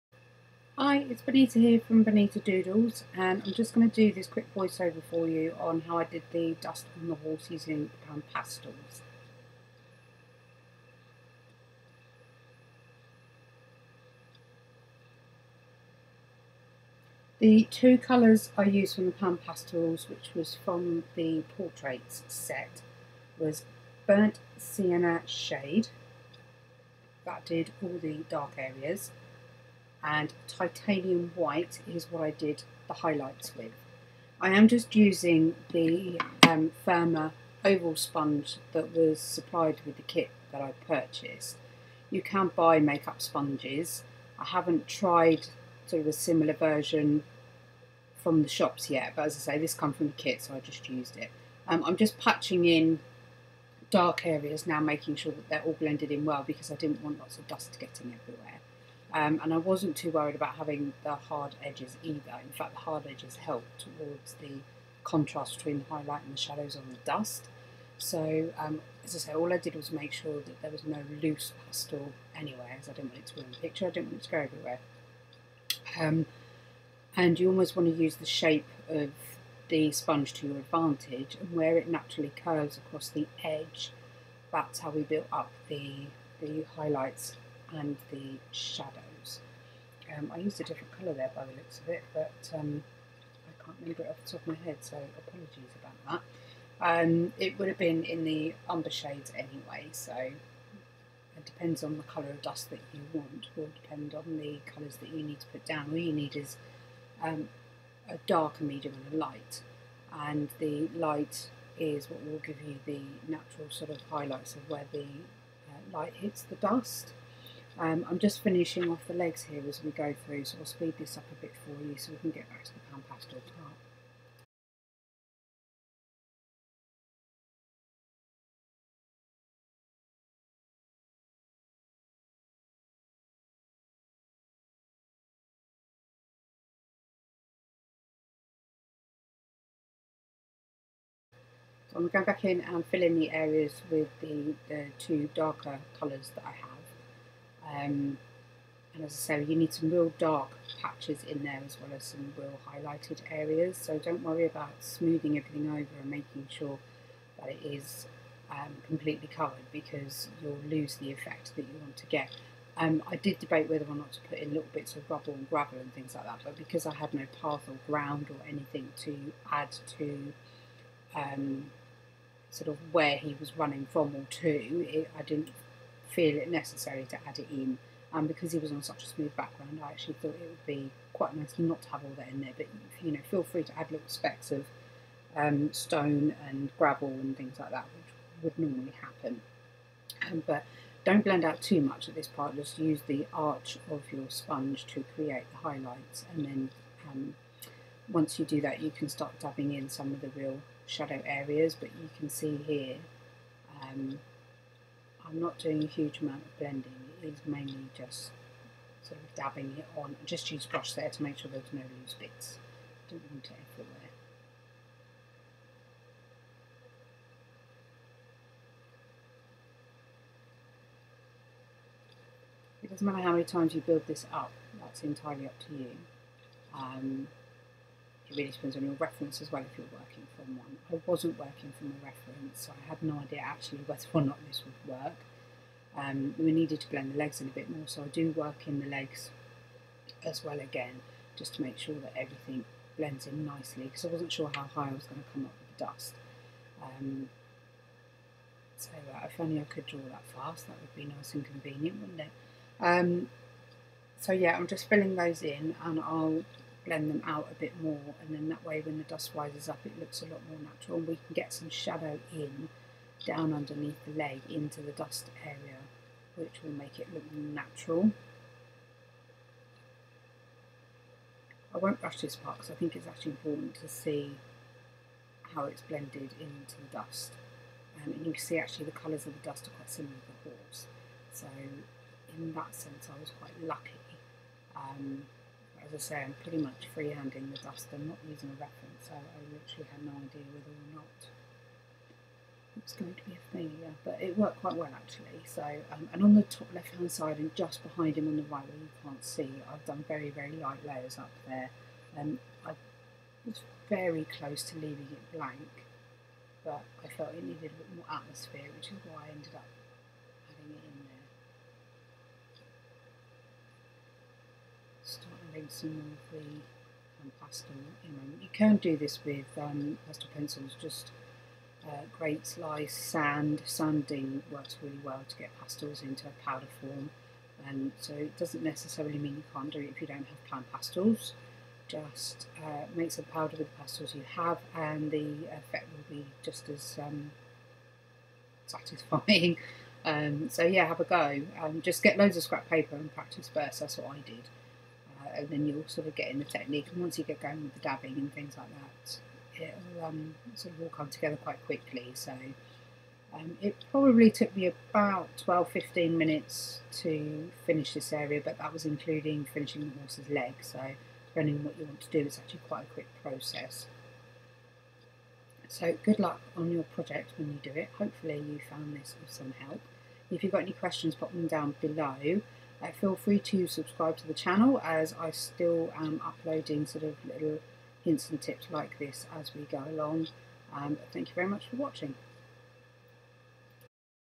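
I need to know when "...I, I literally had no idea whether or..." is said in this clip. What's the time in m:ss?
4:49.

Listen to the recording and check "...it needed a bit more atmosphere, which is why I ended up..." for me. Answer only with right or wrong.
right.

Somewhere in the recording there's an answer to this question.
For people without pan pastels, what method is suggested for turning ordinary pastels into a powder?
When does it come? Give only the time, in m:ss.
5:23.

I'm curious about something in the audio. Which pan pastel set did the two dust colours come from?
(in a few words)
portraits set.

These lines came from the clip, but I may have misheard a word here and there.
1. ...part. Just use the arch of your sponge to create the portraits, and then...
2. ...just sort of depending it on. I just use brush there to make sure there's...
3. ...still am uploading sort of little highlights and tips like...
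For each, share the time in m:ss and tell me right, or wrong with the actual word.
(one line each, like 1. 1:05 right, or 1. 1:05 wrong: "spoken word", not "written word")
1. 3:12 wrong: "highlights", not "portraits"
2. 3:27 wrong: "dabbing", not "depending"
3. 6:15 wrong: "hints", not "highlights".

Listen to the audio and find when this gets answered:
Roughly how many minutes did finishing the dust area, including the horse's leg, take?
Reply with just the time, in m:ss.
5:55.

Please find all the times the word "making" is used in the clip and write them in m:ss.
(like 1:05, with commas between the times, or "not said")
0:54, 2:36.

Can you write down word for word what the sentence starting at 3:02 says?
But you know, feel free to add little specks of um, stone and gravel and things like that, which would normally happen.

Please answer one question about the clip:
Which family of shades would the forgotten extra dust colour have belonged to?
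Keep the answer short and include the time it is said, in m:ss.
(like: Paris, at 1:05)
umber shades, at 1:38.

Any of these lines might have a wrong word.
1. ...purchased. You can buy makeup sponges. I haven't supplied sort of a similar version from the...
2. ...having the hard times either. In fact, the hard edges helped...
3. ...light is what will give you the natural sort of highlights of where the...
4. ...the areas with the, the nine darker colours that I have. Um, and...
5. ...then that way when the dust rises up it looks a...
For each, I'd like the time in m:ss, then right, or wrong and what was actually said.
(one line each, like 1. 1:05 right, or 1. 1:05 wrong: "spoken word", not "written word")
1. 0:40 wrong: "tried", not "supplied"
2. 1:00 wrong: "edges", not "times"
3. 1:50 right
4. 2:23 wrong: "two", not "nine"
5. 4:18 right.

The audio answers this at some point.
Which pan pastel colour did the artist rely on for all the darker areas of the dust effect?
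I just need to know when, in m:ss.
0:24.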